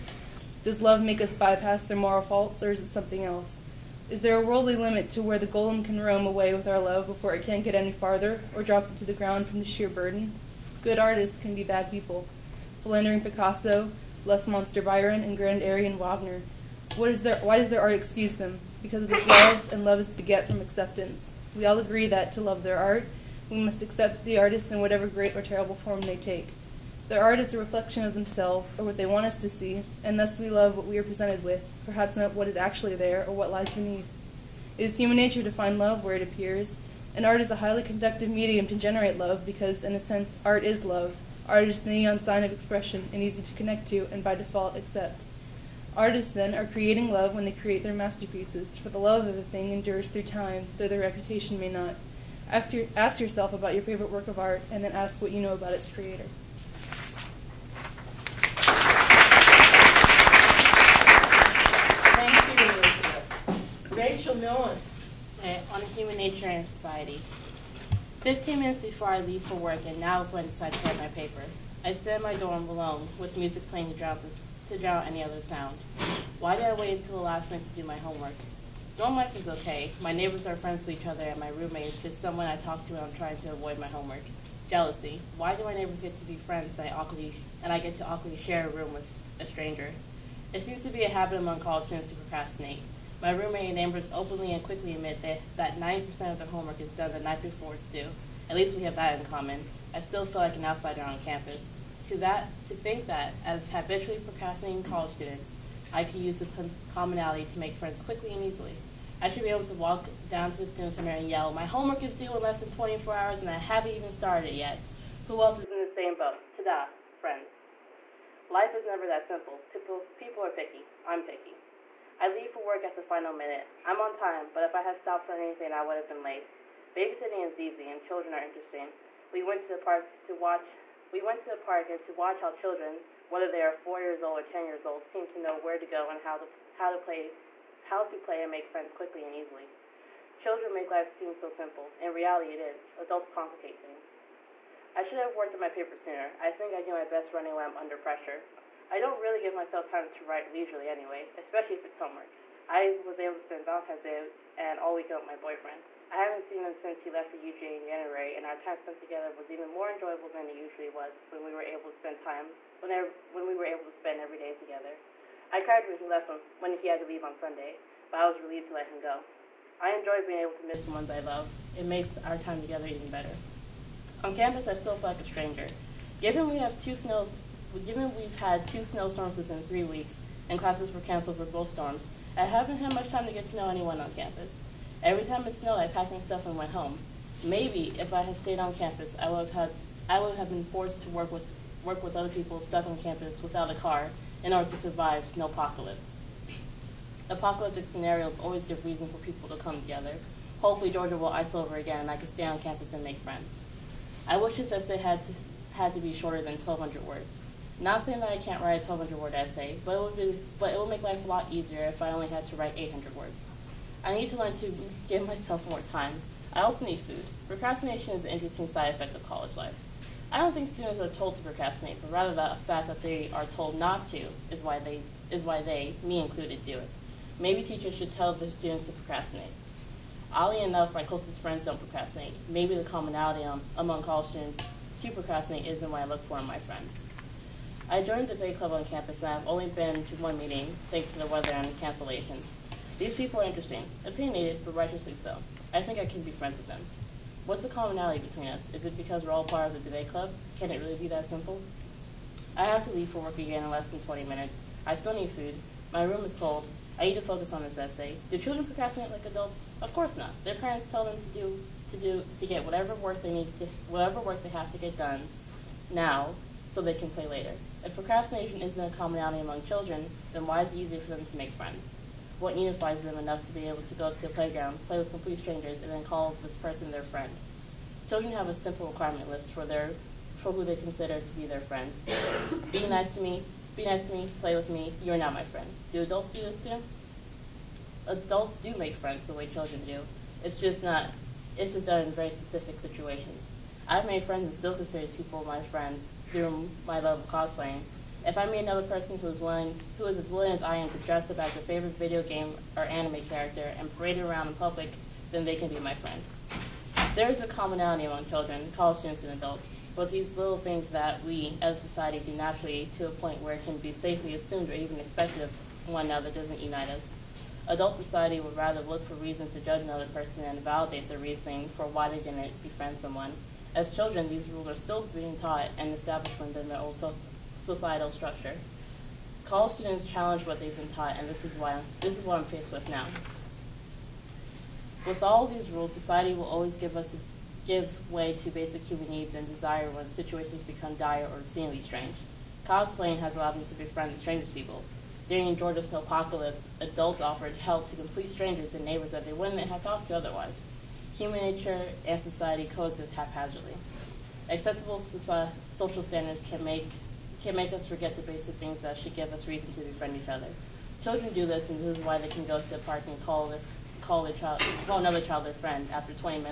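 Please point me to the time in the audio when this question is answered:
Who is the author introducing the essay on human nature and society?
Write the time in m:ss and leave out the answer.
1:04.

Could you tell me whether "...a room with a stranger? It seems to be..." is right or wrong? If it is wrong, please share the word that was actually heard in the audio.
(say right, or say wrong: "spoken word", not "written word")
right.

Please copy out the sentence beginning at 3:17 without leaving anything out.
Apocalyptic scenarios always give reason for people to come together.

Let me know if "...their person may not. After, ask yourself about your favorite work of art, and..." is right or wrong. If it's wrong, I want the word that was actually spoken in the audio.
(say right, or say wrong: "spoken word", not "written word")
wrong: "reputation", not "person".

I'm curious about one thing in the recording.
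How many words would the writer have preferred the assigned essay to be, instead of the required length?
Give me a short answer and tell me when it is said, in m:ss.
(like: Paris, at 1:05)
800, at 3:32.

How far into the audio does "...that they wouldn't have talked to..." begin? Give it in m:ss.
5:49.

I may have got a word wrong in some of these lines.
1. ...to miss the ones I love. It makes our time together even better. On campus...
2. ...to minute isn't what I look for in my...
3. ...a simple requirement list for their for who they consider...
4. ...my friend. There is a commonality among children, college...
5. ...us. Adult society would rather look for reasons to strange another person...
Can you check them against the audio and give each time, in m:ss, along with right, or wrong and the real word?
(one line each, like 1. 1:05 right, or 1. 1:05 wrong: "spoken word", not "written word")
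1. 2:50 right
2. 3:55 wrong: "procrastinate", not "minute"
3. 4:38 right
4. 5:05 right
5. 5:16 wrong: "judge", not "strange".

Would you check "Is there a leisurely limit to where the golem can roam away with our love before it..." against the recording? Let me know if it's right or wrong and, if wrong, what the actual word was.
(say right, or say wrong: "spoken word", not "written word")
wrong: "worldly", not "leisurely".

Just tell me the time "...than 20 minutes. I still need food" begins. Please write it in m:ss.
4:13.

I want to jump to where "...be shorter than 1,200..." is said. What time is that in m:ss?
3:25.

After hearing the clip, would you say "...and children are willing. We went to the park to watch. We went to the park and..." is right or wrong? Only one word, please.
wrong.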